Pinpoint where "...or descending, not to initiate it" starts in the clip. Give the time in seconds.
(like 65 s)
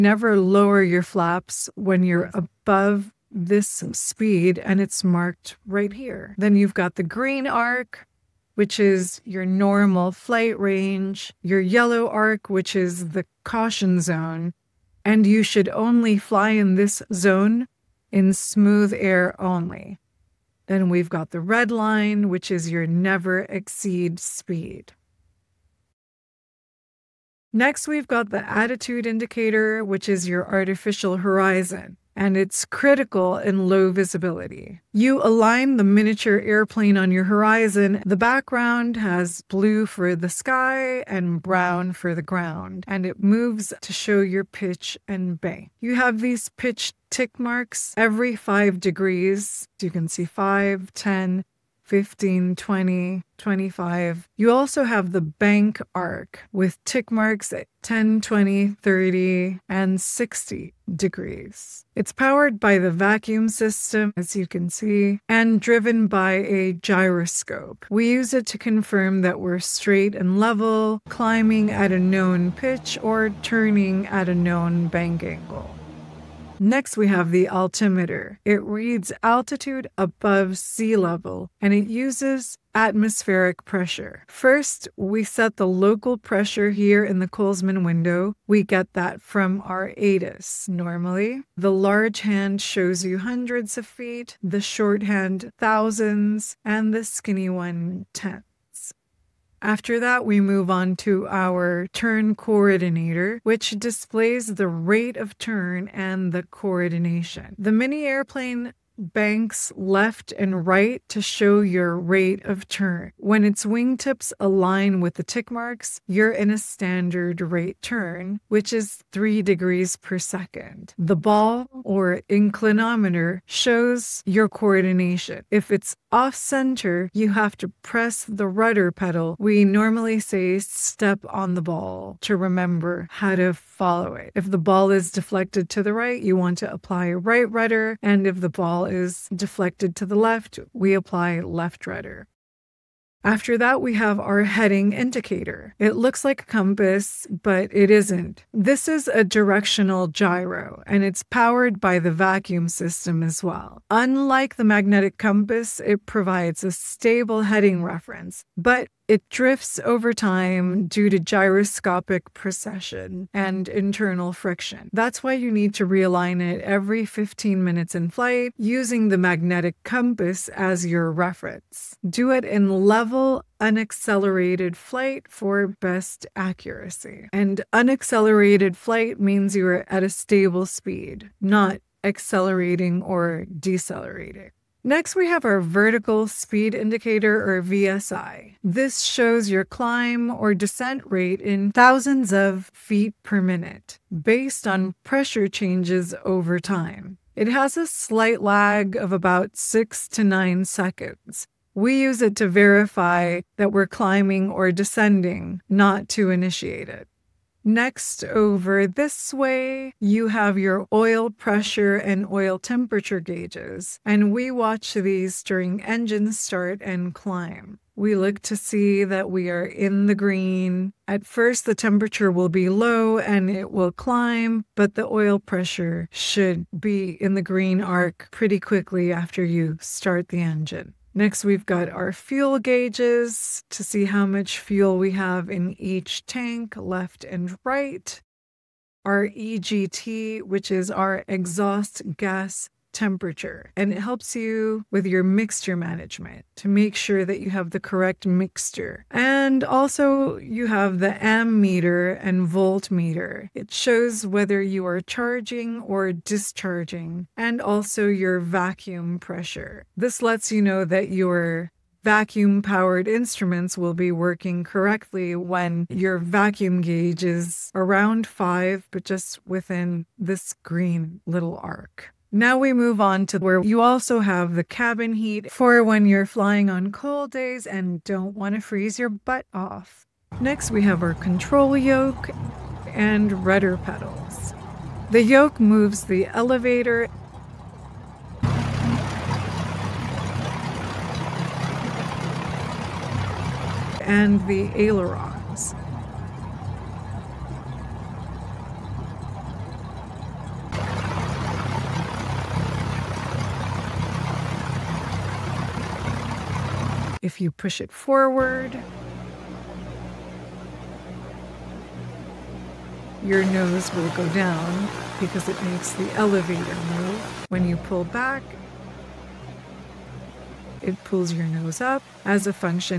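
204 s.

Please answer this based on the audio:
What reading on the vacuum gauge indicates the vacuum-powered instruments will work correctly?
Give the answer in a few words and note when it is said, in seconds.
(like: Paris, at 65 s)
around 5, at 267 s.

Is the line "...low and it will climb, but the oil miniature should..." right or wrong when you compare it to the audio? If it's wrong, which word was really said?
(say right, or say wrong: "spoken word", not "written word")
wrong: "pressure", not "miniature".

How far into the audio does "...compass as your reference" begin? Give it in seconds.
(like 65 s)
169 s.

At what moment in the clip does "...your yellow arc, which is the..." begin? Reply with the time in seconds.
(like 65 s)
11 s.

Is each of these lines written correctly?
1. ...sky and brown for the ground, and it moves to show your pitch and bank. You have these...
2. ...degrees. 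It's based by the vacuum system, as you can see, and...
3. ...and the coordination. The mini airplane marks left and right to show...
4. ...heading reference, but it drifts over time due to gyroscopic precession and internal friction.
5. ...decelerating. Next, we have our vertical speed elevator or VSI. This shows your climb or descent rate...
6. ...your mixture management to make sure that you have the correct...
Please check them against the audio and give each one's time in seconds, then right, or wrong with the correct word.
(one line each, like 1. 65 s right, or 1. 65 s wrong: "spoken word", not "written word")
1. 40 s right
2. 60 s wrong: "powered", not "based"
3. 105 s wrong: "banks", not "marks"
4. 157 s right
5. 183 s wrong: "indicator", not "elevator"
6. 245 s right.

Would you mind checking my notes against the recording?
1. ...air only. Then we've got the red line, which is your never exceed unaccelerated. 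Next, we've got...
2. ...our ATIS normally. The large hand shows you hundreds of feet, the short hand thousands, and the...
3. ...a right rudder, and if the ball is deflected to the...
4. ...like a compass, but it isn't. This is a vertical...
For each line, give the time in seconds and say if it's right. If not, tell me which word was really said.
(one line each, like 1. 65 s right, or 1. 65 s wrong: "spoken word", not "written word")
1. 18 s wrong: "speed", not "unaccelerated"
2. 89 s right
3. 137 s right
4. 146 s wrong: "directional", not "vertical".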